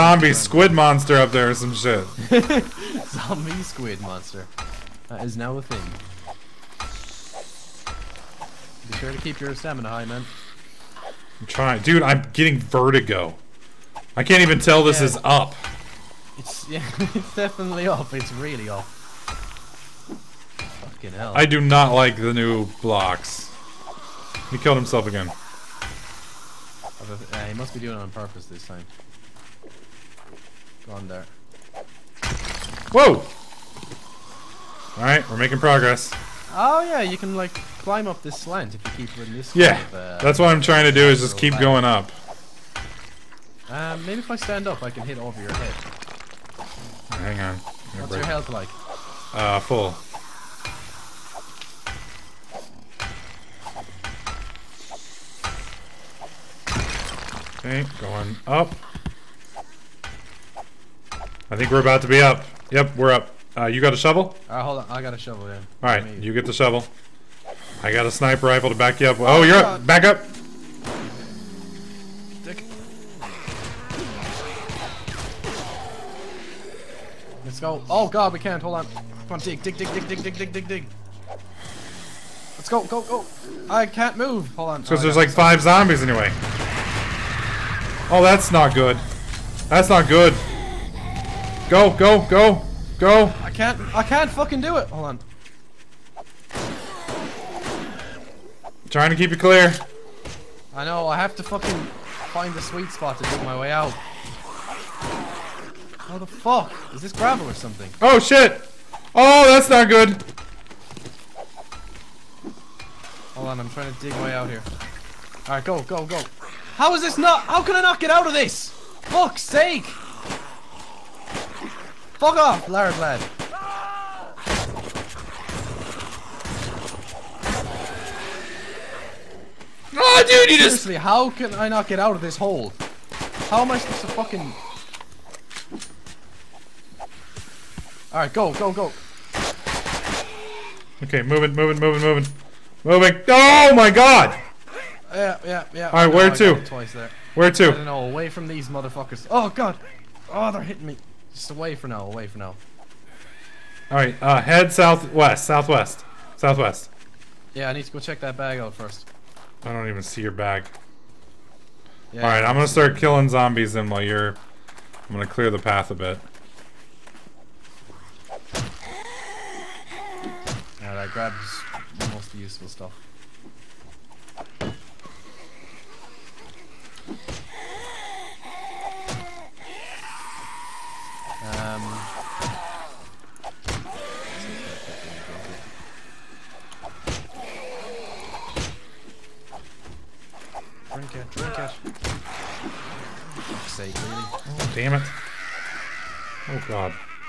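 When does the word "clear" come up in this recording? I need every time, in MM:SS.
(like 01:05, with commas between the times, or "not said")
01:39, 02:45.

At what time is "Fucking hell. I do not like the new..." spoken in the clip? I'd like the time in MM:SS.
00:20.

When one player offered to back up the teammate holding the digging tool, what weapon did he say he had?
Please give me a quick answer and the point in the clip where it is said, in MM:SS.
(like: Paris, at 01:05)
Sniper rifle, at 01:08.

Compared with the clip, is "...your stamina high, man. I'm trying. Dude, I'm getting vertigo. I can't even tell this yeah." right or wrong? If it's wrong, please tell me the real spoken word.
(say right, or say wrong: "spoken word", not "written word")
right.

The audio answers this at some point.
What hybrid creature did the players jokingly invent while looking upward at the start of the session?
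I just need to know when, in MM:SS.
00:03.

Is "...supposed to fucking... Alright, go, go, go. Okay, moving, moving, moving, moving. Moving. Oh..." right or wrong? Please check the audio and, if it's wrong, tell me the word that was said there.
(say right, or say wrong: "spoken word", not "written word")
right.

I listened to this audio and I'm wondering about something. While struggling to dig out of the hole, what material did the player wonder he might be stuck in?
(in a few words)
Gravel.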